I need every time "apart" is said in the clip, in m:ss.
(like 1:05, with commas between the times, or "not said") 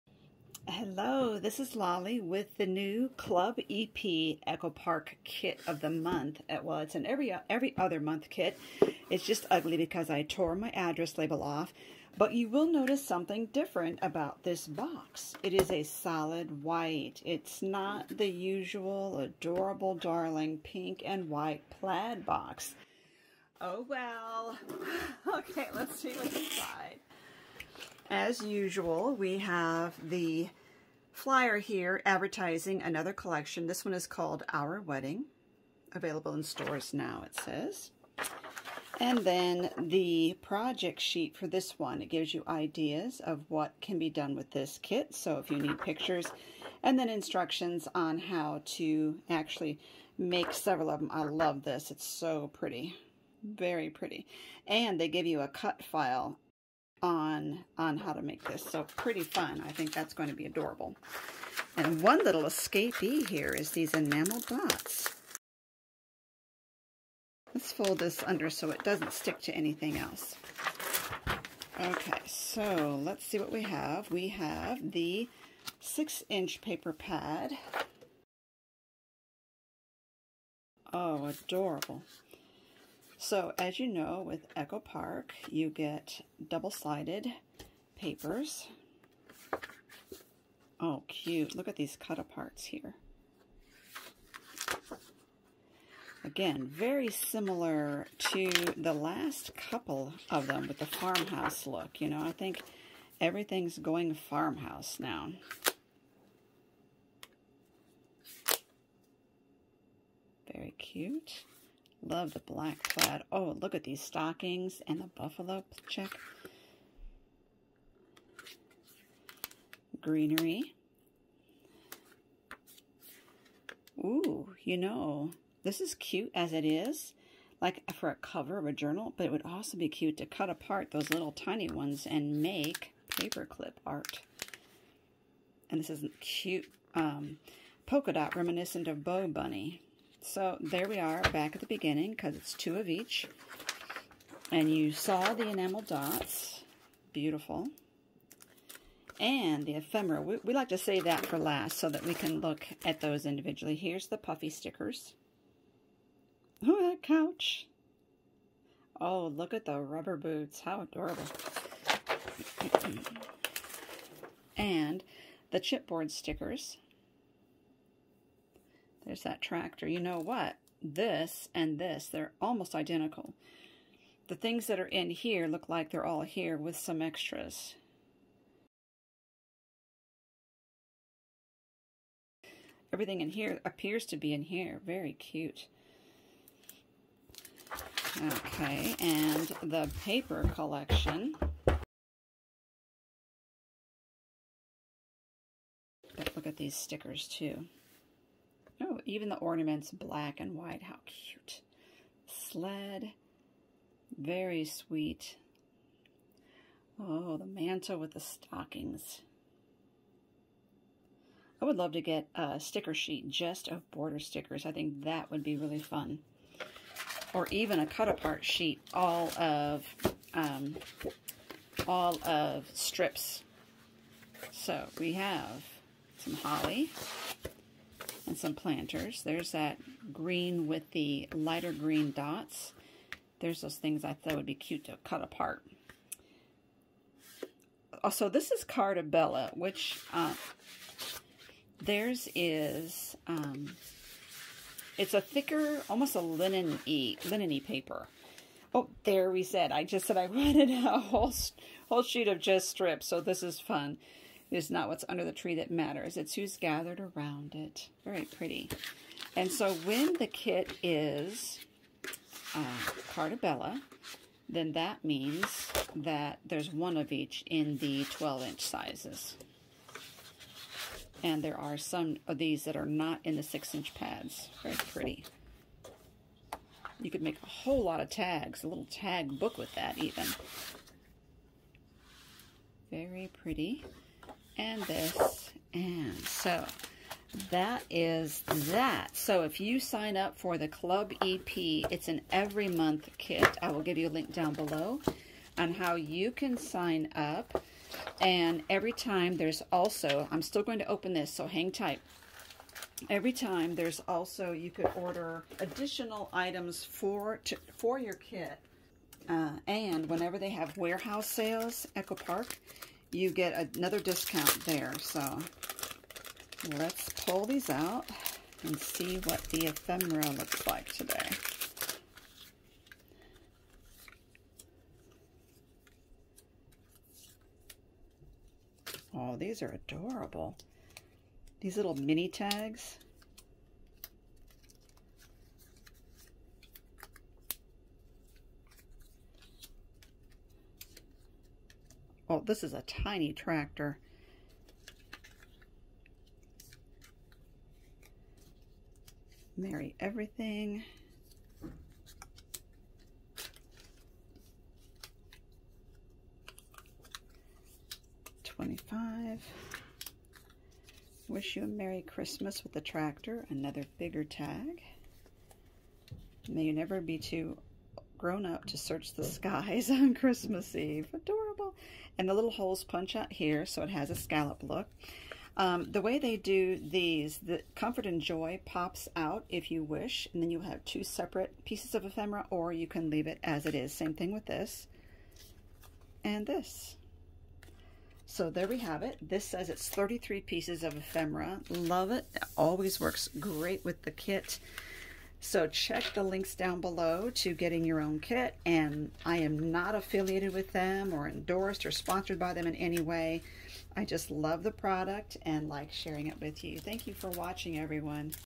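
1:32, 2:10, 3:37, 3:55.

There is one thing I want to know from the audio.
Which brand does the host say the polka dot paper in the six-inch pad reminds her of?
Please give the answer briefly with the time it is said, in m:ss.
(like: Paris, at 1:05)
BoBunny, at 2:18.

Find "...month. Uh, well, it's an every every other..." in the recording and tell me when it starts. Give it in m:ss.
0:05.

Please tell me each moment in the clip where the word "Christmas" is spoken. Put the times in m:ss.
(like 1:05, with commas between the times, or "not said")
6:02, 6:10.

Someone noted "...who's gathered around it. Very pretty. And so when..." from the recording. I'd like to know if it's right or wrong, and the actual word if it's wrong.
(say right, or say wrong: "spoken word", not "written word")
right.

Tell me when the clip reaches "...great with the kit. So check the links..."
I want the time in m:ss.
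6:33.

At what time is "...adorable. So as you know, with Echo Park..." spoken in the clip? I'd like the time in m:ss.
1:21.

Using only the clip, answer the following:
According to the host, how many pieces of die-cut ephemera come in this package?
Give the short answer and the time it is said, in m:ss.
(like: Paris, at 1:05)
33, at 6:29.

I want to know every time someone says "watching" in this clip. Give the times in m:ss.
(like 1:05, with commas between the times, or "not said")
6:47.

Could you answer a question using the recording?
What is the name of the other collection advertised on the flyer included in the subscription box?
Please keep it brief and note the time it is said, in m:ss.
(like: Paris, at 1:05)
Our Wedding, at 0:34.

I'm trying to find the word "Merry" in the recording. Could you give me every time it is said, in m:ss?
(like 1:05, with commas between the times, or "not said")
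5:49, 6:01.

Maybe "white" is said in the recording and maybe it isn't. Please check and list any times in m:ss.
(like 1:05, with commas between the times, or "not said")
0:16, 0:21, 3:20.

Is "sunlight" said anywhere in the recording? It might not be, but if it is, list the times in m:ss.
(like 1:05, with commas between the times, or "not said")
not said.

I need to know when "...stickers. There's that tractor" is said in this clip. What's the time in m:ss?
2:46.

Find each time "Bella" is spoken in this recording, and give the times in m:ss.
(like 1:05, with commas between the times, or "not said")
3:59, 4:23.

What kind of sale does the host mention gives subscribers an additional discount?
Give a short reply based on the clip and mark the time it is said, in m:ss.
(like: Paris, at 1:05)
Warehouse sales, at 5:10.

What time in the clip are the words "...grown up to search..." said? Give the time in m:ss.
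6:08.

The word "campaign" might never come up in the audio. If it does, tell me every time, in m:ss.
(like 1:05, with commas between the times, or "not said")
not said.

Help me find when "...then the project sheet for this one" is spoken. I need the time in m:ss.
0:39.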